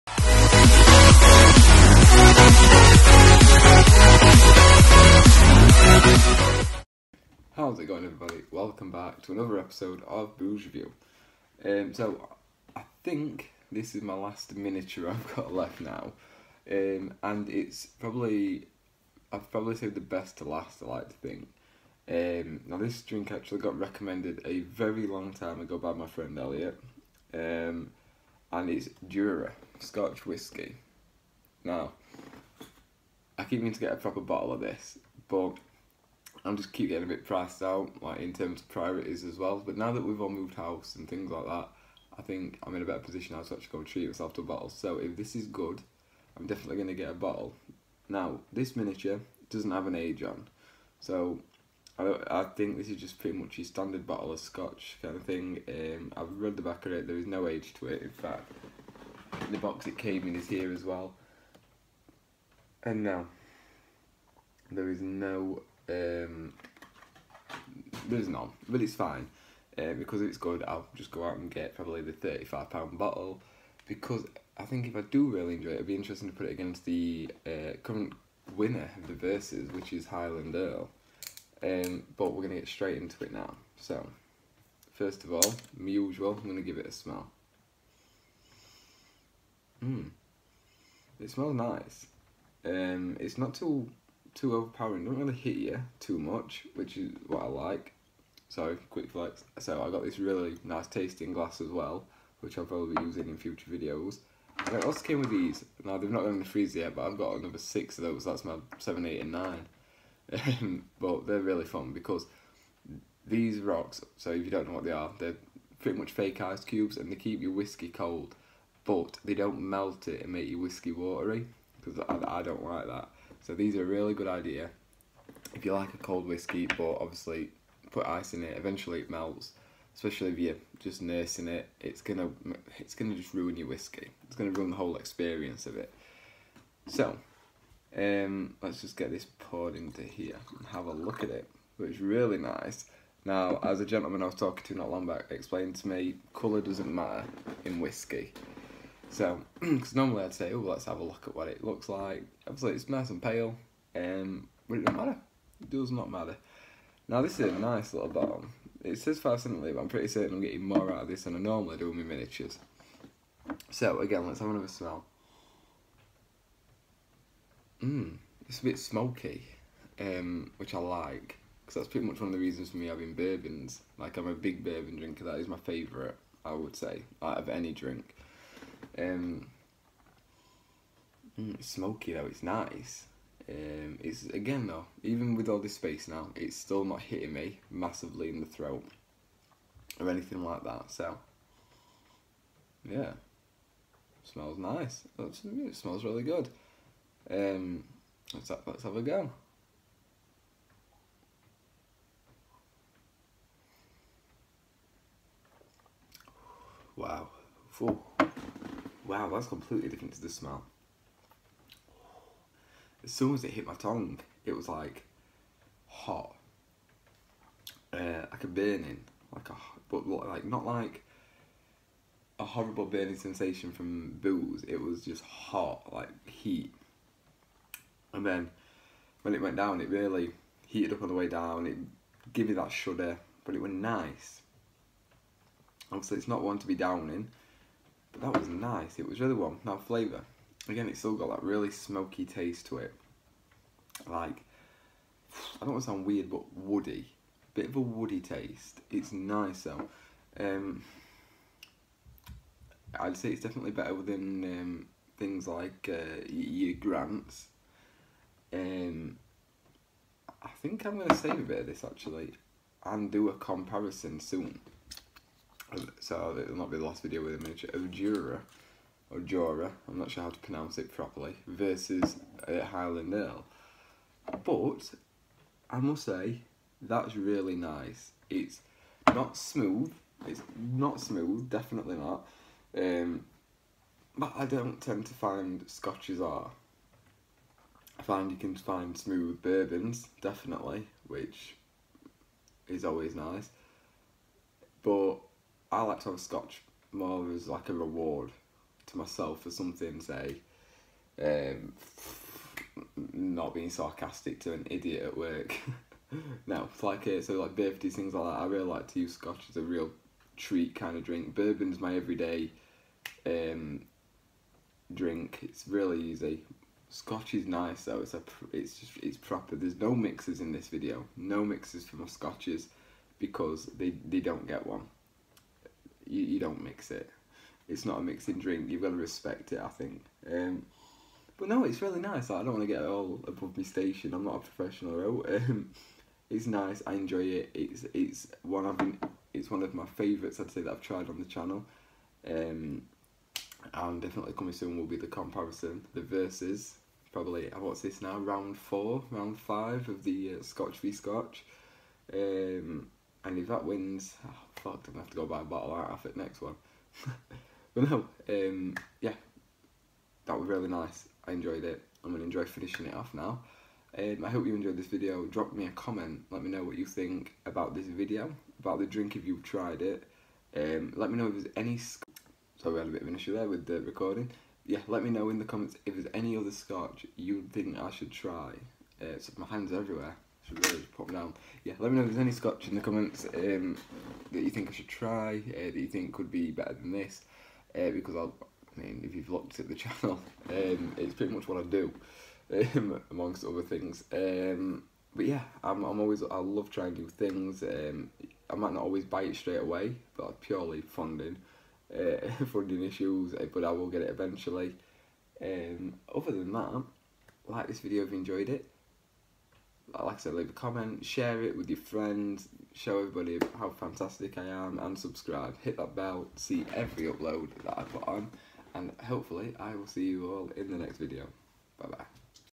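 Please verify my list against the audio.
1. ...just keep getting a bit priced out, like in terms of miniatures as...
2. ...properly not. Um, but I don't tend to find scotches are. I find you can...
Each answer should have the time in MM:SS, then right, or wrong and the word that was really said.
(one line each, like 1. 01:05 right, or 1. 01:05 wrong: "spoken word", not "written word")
1. 00:36 wrong: "priorities", not "miniatures"
2. 04:41 wrong: "definitely", not "properly".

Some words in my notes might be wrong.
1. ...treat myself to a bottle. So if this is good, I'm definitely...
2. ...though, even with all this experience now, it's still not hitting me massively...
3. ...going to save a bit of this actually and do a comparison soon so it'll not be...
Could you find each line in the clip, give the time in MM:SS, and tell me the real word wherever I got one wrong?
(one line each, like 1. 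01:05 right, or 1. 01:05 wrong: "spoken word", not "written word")
1. 00:43 right
2. 03:04 wrong: "space", not "experience"
3. 04:20 right.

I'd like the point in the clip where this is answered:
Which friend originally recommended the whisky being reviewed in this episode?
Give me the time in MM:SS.
00:26.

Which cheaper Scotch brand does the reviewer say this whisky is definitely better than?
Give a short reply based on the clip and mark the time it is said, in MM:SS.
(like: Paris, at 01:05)
Grant's, at 04:16.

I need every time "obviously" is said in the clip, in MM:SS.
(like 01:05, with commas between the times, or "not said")
02:06, 02:32, 03:55.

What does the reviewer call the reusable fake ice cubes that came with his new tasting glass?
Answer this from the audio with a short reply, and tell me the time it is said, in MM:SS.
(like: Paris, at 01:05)
rocks, at 01:53.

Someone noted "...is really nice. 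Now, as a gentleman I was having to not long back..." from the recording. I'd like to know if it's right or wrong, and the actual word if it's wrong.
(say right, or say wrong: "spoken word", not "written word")
wrong: "talking", not "having".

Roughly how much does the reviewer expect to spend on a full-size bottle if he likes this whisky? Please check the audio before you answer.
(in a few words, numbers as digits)
£35.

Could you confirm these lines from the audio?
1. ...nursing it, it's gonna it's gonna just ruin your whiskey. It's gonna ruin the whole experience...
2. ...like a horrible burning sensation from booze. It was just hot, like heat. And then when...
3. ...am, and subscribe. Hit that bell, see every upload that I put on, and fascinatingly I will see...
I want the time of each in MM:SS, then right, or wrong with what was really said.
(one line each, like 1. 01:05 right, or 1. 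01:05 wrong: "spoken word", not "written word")
1. 02:11 right
2. 03:40 right
3. 06:54 wrong: "hopefully", not "fascinatingly".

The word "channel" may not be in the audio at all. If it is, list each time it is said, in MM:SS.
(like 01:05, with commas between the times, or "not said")
05:41, 06:29.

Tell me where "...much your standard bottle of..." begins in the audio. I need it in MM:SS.
00:53.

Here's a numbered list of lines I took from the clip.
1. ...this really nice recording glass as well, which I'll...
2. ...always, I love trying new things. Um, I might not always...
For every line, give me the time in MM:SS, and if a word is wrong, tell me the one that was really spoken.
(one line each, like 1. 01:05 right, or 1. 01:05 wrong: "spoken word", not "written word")
1. 01:40 wrong: "tasting", not "recording"
2. 06:35 right.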